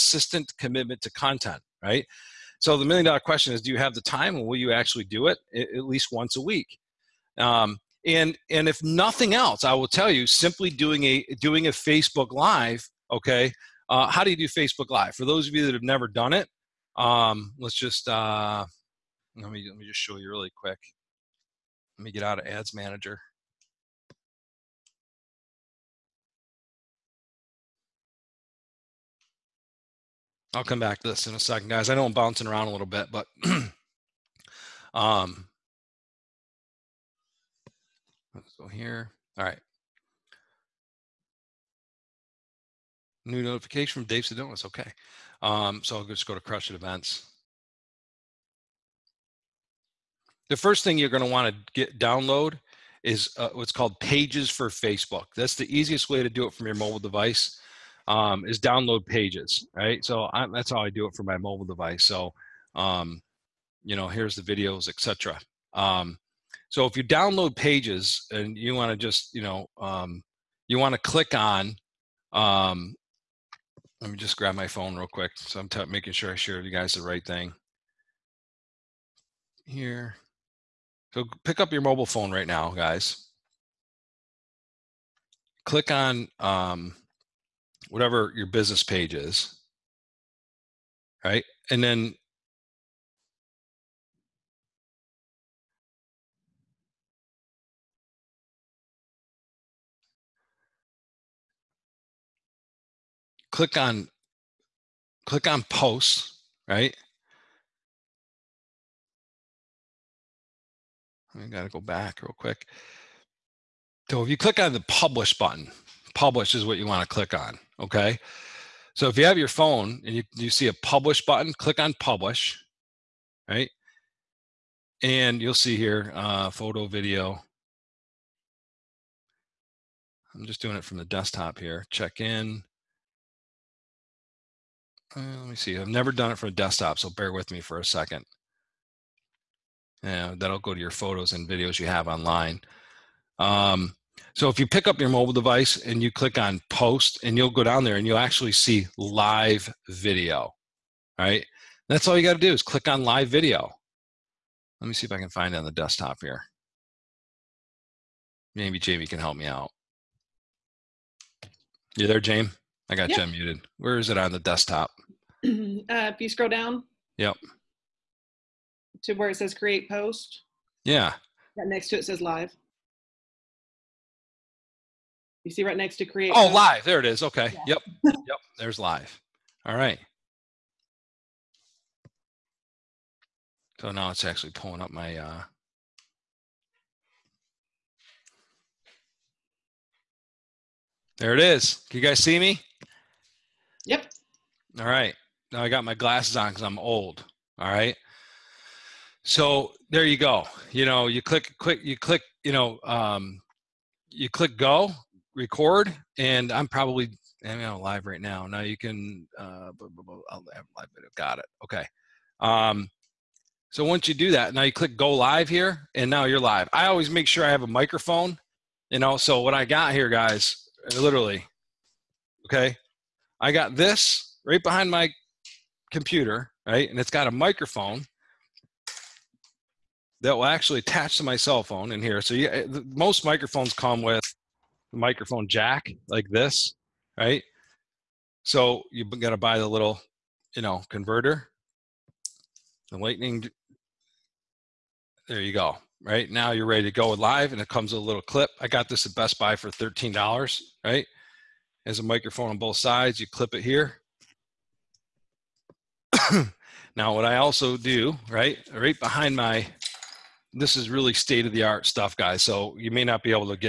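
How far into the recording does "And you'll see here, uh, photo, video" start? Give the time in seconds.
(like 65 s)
125 s.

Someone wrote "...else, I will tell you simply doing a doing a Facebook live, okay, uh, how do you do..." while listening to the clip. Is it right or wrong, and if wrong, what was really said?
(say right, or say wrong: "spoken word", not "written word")
right.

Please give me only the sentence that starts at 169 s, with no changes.
To where it says create post.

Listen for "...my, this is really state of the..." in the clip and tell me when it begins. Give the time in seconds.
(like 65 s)
259 s.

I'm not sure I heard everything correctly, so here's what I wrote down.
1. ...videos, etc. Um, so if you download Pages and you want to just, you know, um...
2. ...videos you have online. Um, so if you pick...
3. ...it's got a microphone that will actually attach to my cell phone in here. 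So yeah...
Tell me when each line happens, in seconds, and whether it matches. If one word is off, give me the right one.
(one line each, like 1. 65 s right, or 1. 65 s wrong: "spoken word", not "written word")
1. 64 s right
2. 141 s right
3. 226 s right.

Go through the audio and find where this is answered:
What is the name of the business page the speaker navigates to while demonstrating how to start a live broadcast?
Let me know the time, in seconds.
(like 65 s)
46 s.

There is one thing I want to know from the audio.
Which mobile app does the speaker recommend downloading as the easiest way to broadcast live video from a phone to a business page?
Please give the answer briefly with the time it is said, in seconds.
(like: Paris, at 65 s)
Pages for Facebook, at 53 s.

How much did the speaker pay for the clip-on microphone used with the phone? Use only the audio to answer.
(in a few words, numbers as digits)
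$13.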